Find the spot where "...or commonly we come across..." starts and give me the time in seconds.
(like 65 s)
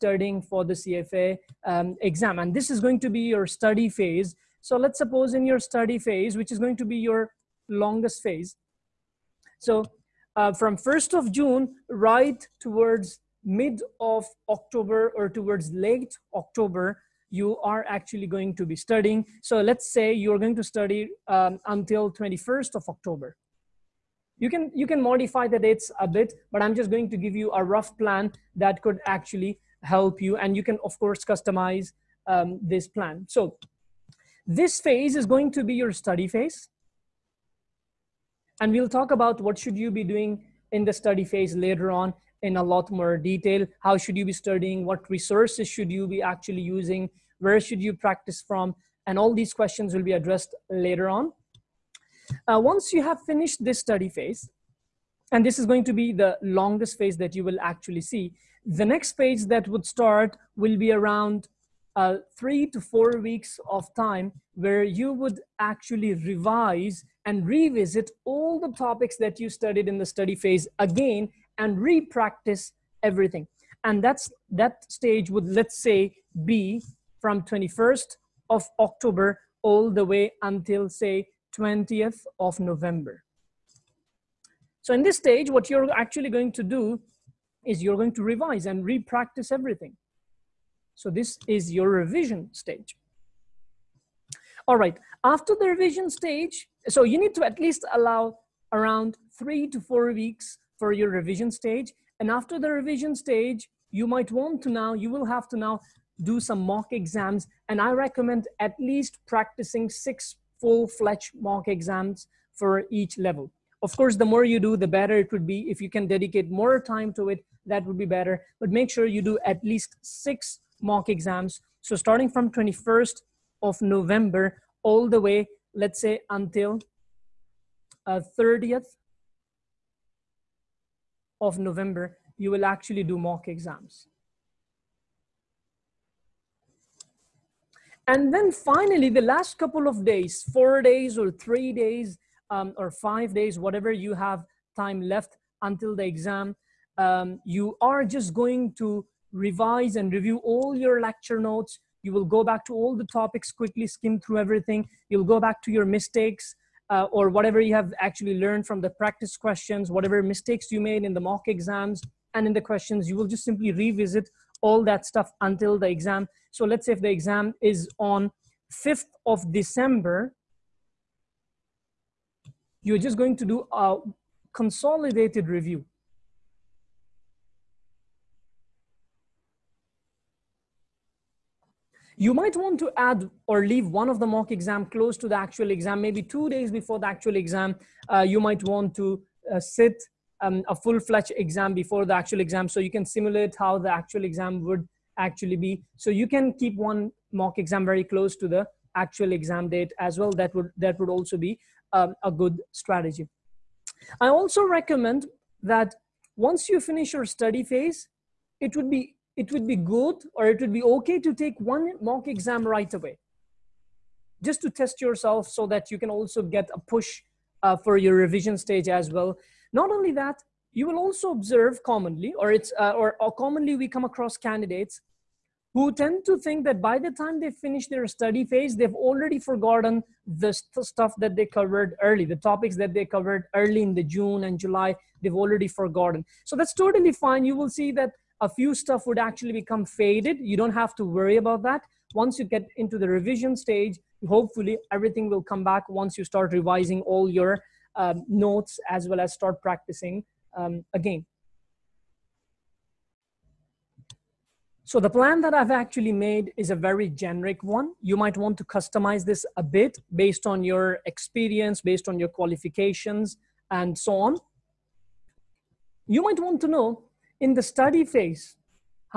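223 s.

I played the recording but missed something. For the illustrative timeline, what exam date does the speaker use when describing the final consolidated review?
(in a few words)
5th of December.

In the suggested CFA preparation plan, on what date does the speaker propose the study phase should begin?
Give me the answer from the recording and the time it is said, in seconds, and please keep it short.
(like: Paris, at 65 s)
1st of June, at 10 s.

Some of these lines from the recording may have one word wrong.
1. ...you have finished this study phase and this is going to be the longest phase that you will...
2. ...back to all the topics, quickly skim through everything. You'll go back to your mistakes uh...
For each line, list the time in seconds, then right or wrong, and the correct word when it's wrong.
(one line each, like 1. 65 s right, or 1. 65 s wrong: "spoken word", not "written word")
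1. 52 s right
2. 152 s right.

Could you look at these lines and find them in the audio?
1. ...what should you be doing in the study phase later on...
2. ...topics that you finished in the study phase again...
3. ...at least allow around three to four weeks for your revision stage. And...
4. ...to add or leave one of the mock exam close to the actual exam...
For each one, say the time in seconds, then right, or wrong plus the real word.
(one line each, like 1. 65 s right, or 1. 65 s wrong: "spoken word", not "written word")
1. 39 s right
2. 68 s wrong: "studied", not "finished"
3. 97 s right
4. 182 s right.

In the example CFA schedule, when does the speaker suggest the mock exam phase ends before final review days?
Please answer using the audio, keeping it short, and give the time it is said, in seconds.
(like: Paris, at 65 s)
30th of November, at 128 s.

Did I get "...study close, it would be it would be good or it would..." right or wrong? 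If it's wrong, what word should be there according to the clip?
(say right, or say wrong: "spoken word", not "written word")
wrong: "phase", not "close".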